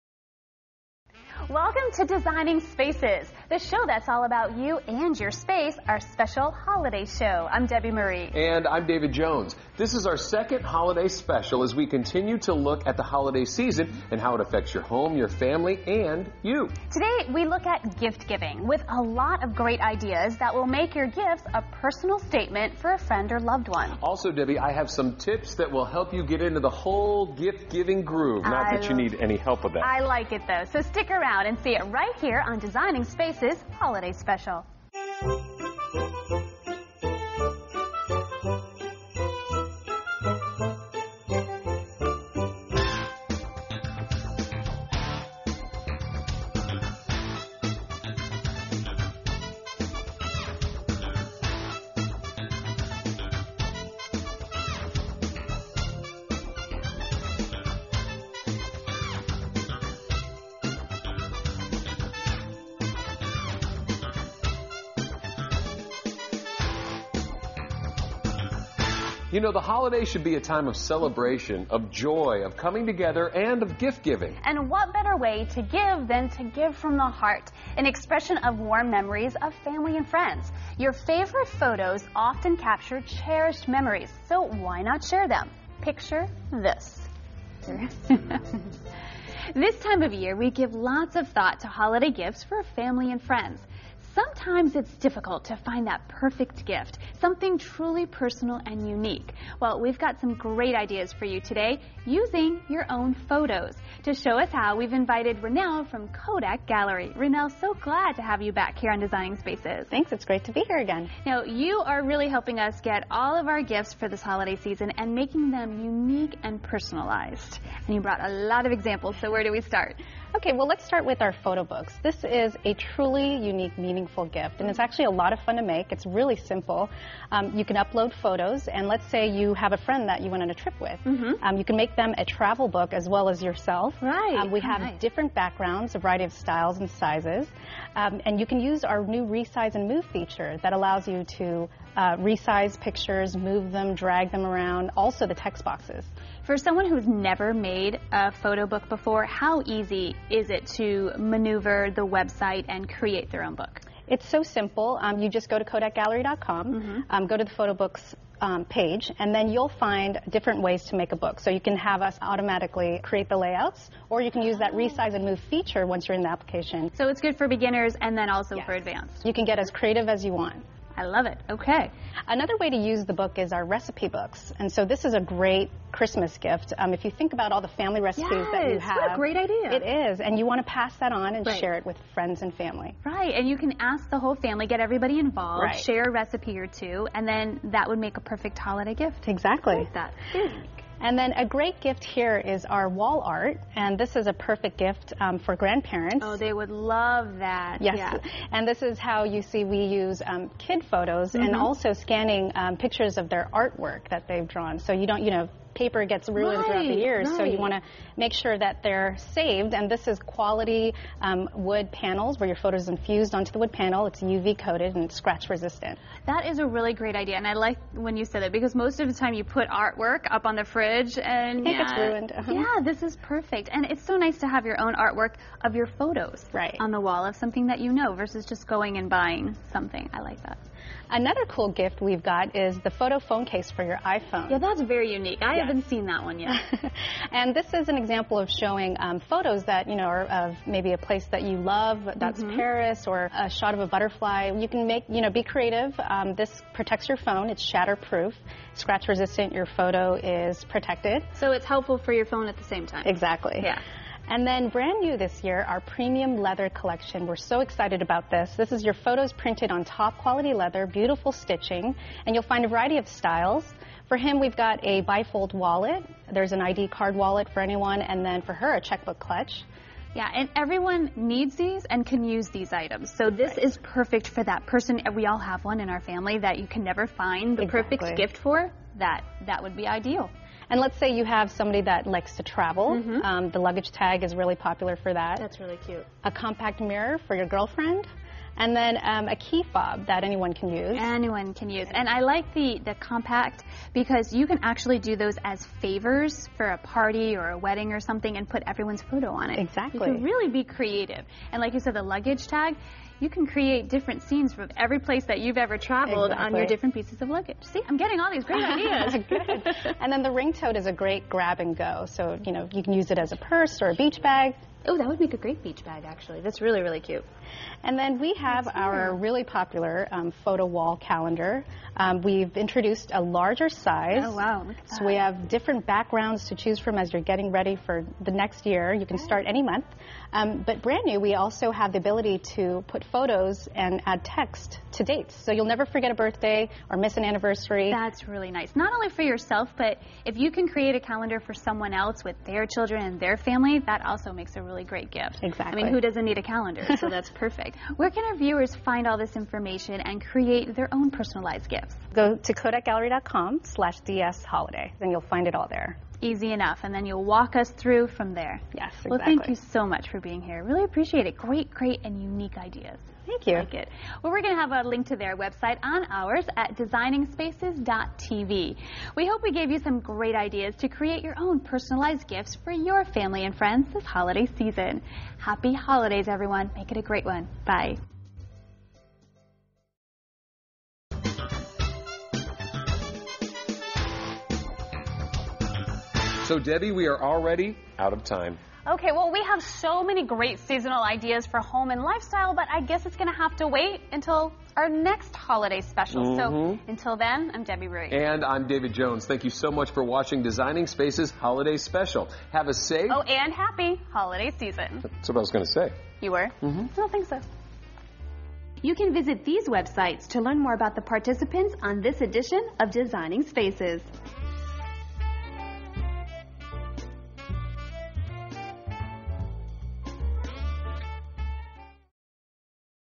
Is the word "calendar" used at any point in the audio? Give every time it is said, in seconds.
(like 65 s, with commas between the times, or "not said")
320 s, 341 s, 346 s.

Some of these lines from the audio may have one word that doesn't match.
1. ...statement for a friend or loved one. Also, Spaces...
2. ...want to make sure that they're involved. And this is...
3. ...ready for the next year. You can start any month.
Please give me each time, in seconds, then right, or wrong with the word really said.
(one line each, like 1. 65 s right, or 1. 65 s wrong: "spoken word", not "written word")
1. 22 s wrong: "Debi", not "Spaces"
2. 207 s wrong: "saved", not "involved"
3. 327 s right.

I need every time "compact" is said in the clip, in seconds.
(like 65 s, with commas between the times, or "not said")
286 s, 292 s.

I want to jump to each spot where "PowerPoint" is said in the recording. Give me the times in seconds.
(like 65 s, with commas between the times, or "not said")
not said.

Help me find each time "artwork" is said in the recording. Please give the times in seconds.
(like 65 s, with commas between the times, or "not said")
203 s, 219 s, 224 s.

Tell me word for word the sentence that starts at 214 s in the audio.
It's UV coated and scratch resistant.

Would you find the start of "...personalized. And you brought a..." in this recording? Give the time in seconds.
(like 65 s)
116 s.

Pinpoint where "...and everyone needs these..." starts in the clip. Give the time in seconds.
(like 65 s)
270 s.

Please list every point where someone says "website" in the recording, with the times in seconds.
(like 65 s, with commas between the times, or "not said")
152 s, 365 s, 409 s.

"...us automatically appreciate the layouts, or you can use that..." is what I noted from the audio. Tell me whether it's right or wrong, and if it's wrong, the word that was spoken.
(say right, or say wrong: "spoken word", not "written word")
wrong: "create", not "appreciate".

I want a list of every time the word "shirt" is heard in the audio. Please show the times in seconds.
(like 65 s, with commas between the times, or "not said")
not said.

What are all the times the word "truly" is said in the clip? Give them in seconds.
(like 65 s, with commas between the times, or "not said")
97 s, 122 s.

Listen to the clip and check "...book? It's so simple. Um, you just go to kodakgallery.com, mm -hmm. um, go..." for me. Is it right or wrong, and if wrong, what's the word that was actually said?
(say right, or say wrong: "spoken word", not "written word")
right.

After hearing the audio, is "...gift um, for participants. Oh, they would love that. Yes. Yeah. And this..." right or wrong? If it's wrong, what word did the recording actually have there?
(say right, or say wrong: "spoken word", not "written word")
wrong: "grandparents", not "participants".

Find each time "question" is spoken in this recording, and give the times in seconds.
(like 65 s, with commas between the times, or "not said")
not said.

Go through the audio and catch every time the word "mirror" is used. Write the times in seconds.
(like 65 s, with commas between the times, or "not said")
286 s.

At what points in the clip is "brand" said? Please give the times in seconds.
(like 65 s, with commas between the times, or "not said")
254 s, 330 s.